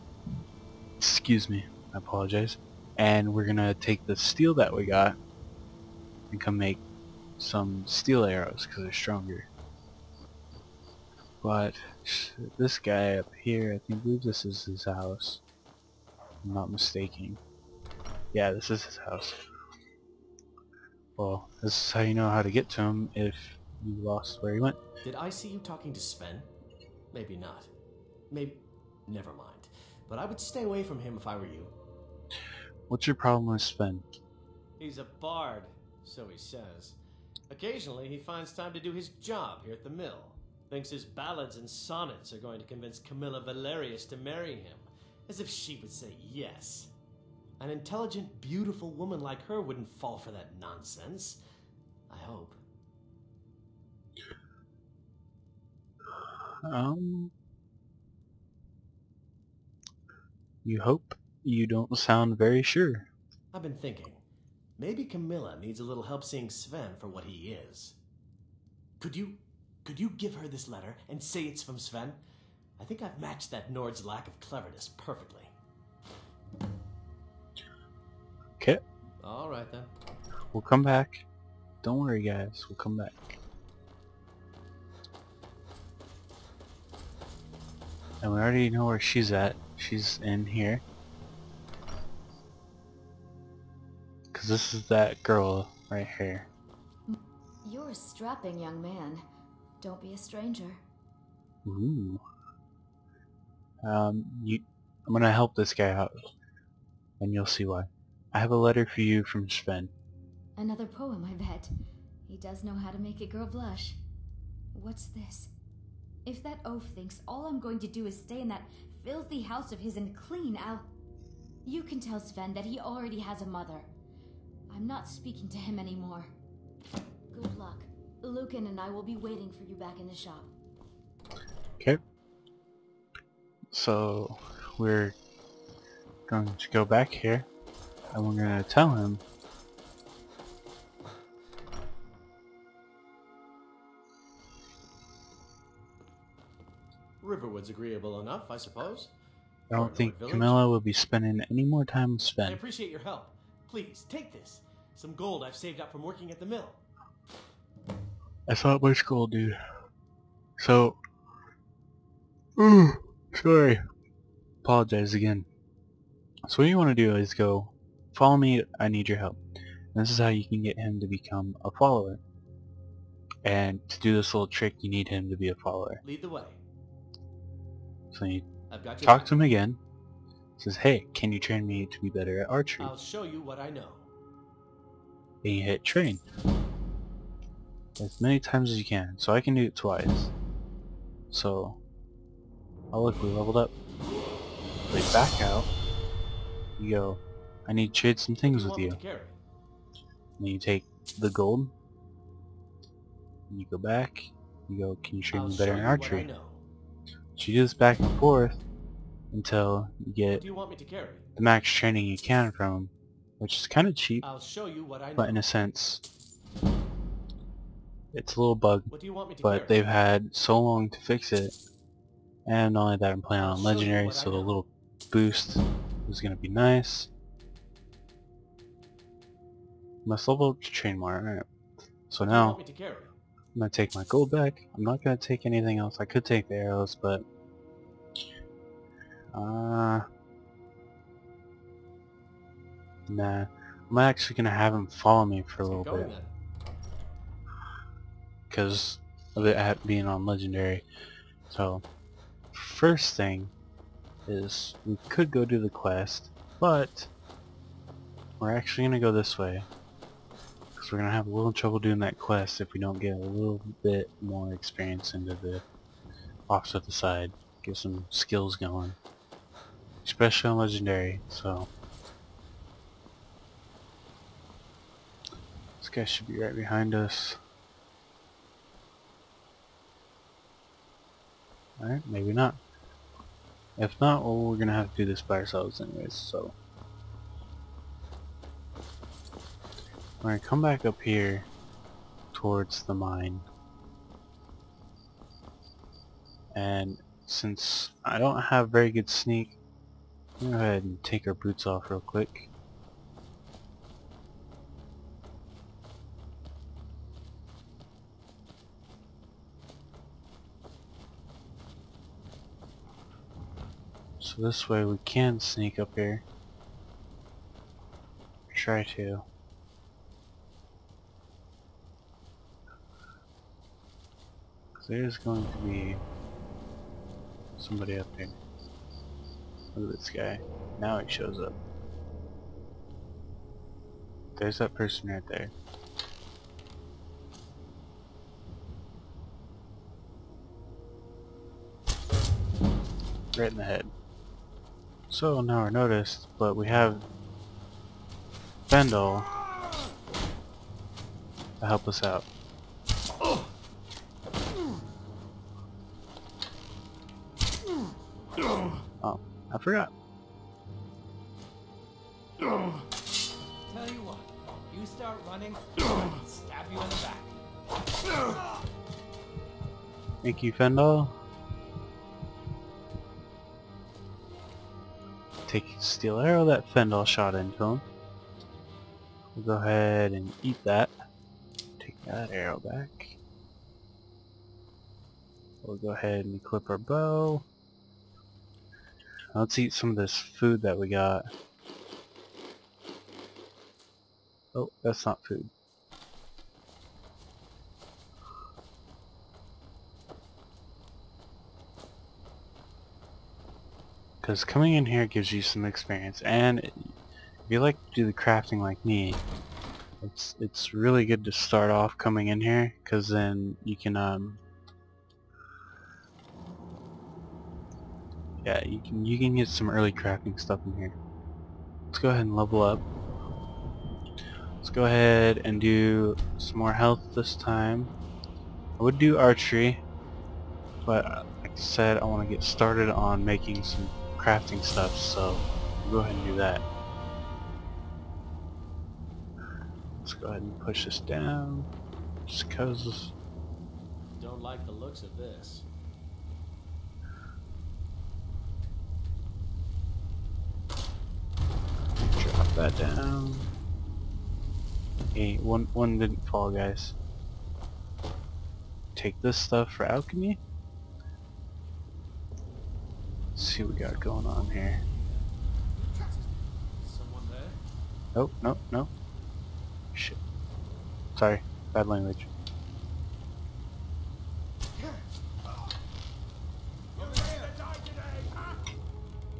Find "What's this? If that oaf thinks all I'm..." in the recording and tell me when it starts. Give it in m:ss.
1:54.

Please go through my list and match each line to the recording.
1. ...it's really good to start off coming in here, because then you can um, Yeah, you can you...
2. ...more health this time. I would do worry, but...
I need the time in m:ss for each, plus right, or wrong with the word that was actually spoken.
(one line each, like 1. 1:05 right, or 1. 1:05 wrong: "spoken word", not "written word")
1. 6:50 right
2. 7:06 wrong: "archery", not "worry".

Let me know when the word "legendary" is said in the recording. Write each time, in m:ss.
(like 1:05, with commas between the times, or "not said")
3:43, 4:10, 4:30.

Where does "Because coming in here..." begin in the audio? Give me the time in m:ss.
6:44.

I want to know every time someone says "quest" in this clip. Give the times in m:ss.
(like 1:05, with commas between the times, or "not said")
4:15, 4:22.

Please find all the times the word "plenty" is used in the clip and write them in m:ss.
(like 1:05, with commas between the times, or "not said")
not said.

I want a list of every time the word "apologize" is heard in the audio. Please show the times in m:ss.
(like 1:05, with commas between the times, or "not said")
0:01, 2:44.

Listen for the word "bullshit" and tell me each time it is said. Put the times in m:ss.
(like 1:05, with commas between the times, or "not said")
not said.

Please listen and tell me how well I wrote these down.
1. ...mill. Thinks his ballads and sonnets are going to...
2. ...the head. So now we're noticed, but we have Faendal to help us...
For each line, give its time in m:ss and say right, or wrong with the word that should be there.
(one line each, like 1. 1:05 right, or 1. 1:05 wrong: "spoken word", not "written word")
1. 0:39 right
2. 5:43 right.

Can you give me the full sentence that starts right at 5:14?
So this way we can sneak up here.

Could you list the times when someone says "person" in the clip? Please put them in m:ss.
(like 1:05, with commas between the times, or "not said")
5:34.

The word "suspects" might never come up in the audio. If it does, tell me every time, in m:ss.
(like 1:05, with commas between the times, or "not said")
not said.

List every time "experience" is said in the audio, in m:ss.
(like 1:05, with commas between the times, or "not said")
4:24, 6:45.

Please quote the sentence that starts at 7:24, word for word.
Don't like the looks of this.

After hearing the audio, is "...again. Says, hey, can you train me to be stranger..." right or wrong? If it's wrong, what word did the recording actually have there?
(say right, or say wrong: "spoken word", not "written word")
wrong: "better", not "stranger".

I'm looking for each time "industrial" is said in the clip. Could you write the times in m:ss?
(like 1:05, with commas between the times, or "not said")
not said.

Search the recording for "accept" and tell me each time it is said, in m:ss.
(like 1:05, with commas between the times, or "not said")
not said.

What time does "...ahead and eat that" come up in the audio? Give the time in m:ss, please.
6:19.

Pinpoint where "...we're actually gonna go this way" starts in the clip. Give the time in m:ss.
4:18.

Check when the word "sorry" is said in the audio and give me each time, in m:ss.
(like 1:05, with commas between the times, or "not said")
2:43, 7:51.